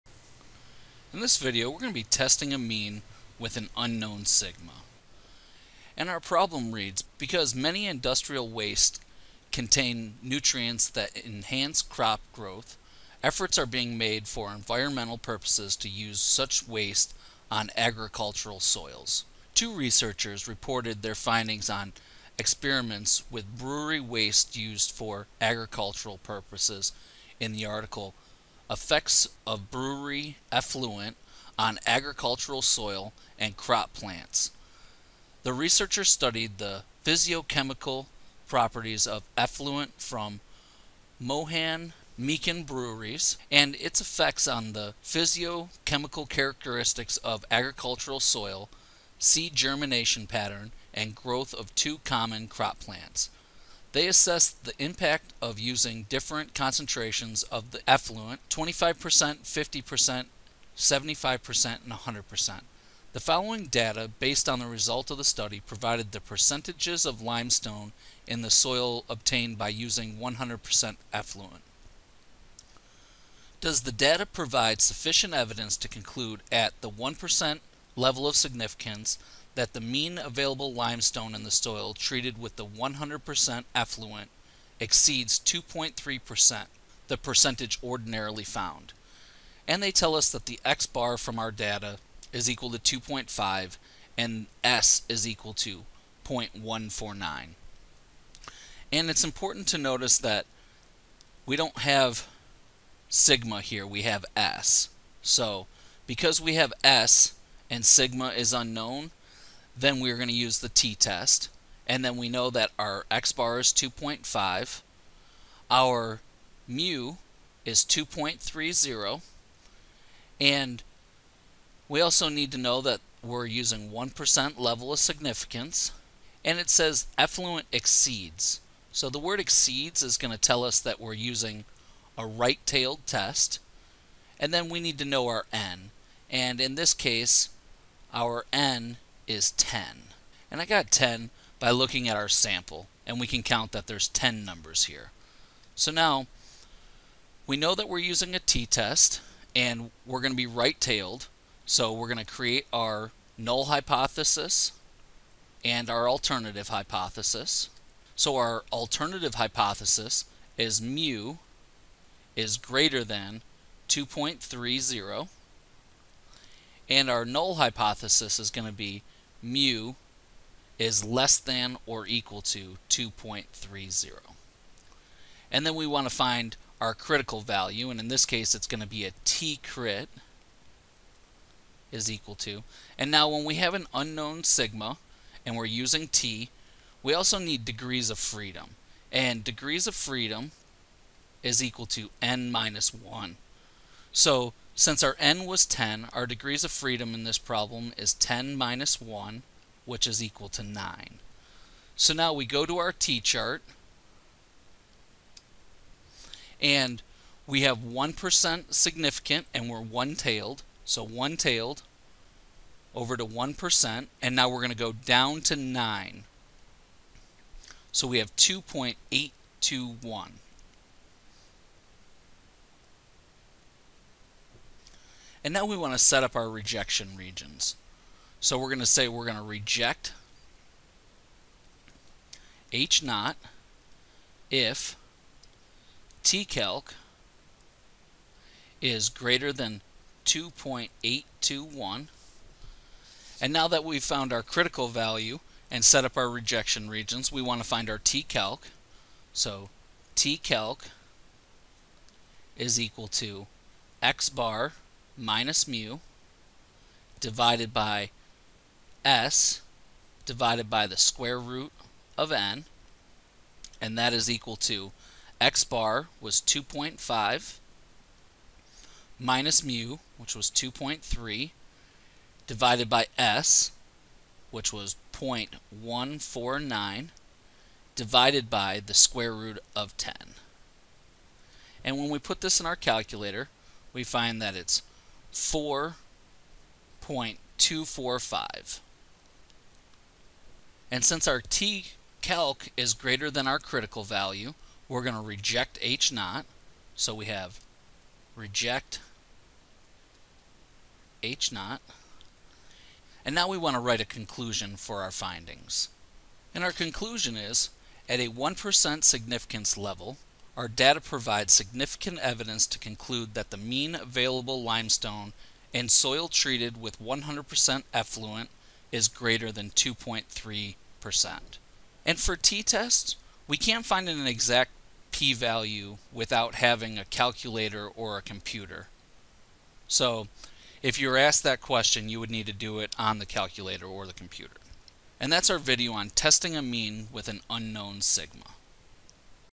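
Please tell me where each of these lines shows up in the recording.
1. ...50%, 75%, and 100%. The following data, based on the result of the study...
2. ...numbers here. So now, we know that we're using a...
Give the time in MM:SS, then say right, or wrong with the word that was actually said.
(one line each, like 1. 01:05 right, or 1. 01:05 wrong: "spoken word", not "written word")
1. 00:58 right
2. 02:24 right.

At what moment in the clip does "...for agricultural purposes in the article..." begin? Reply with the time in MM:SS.
00:24.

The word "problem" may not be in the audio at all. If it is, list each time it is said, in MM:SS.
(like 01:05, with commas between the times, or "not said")
00:06, 03:17.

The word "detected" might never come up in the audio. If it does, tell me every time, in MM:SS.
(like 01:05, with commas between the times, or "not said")
not said.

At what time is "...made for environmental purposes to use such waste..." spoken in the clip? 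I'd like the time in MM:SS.
00:13.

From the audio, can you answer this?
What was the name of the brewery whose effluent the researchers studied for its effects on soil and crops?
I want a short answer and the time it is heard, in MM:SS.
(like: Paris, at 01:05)
Mohan Meakin, at 00:41.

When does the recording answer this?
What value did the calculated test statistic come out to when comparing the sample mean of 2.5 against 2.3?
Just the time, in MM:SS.
04:45.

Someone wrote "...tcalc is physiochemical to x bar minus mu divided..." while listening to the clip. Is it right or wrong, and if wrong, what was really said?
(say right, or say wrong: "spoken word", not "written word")
wrong: "equal", not "physiochemical".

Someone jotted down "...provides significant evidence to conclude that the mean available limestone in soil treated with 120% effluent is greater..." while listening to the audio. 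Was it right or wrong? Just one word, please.
wrong.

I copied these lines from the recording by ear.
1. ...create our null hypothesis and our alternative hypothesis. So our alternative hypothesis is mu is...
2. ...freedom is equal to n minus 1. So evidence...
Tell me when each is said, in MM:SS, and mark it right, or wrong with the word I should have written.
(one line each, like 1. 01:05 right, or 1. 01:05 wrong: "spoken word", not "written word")
1. 02:32 right
2. 03:09 wrong: "since", not "evidence".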